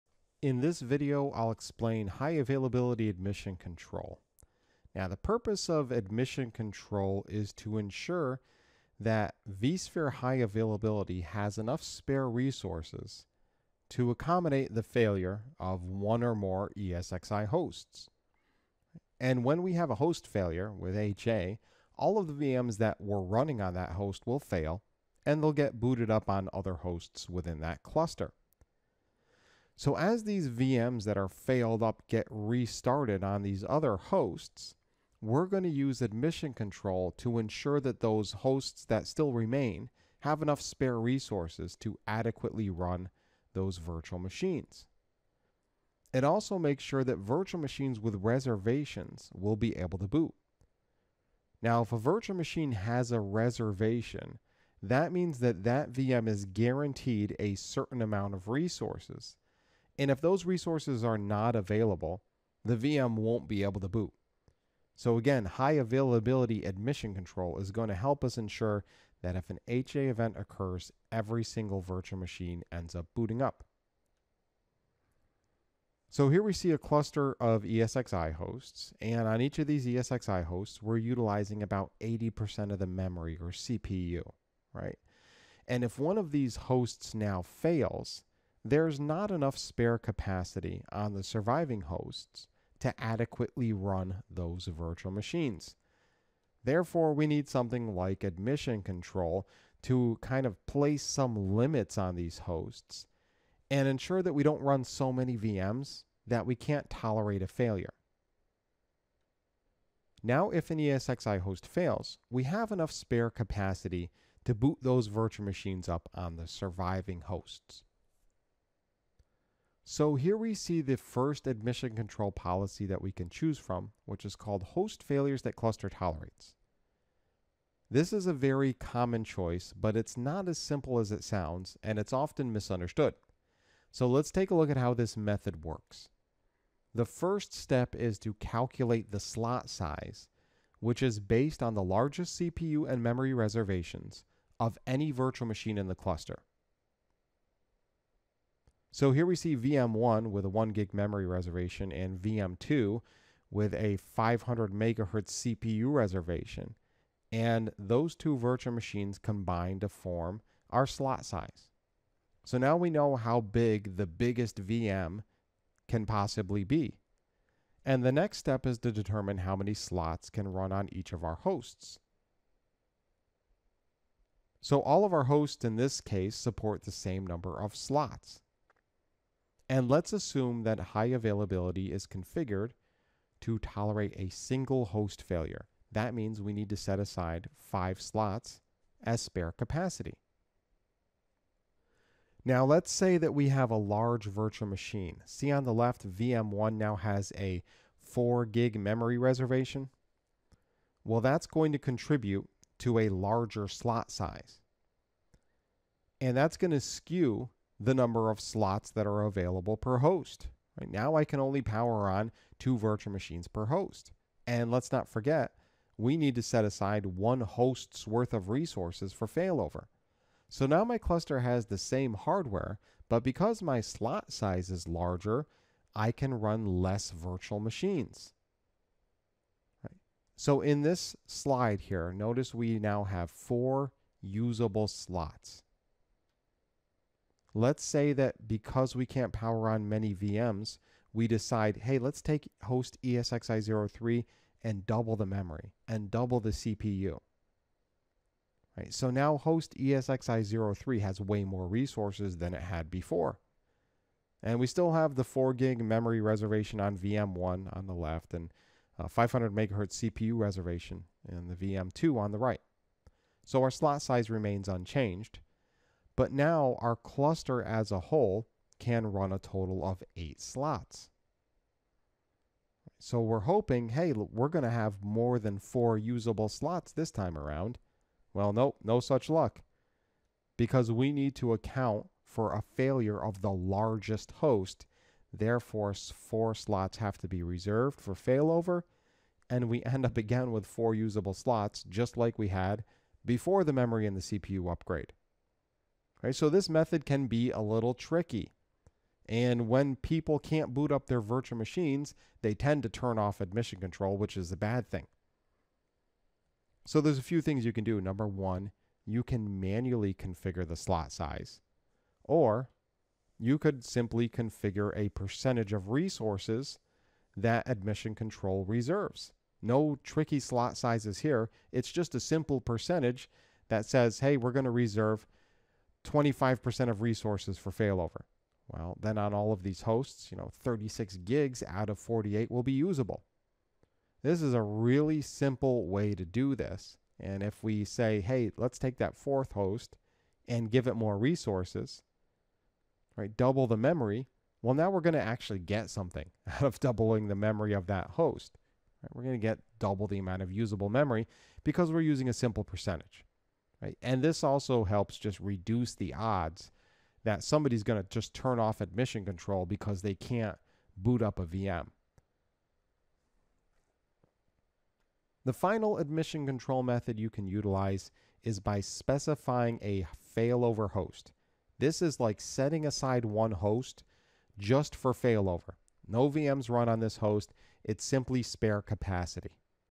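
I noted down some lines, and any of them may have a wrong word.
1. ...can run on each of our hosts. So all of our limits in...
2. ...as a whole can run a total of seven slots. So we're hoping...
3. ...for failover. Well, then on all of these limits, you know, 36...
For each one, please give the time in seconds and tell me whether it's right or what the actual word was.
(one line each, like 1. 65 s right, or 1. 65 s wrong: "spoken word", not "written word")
1. 170 s wrong: "hosts", not "limits"
2. 267 s wrong: "eight", not "seven"
3. 327 s wrong: "hosts", not "limits".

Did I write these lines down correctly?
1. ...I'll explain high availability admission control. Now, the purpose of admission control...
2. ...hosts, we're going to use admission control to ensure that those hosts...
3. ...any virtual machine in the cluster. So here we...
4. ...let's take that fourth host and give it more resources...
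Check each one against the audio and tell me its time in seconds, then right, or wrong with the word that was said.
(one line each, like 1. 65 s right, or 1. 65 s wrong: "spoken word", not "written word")
1. 1 s right
2. 33 s right
3. 144 s right
4. 338 s right.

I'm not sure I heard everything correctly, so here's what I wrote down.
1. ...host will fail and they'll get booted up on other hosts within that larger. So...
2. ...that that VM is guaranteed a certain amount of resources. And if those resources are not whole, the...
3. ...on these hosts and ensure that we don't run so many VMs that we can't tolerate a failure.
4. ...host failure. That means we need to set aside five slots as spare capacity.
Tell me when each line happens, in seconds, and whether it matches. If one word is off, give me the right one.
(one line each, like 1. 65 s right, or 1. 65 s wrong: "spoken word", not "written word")
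1. 23 s wrong: "cluster", not "larger"
2. 55 s wrong: "available", not "whole"
3. 101 s right
4. 184 s right.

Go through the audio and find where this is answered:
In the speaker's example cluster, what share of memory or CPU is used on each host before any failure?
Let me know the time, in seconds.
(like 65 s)
82 s.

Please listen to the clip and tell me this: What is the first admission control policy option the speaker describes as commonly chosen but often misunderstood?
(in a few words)
host failures that cluster tolerates.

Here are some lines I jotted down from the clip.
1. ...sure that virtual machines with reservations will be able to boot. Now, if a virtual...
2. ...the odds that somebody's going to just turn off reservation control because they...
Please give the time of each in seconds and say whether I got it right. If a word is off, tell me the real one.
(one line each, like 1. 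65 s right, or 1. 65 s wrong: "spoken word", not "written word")
1. 46 s right
2. 355 s wrong: "admission", not "reservation".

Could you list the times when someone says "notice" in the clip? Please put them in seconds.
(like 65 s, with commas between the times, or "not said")
232 s.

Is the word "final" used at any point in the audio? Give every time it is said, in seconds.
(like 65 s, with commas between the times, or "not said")
365 s.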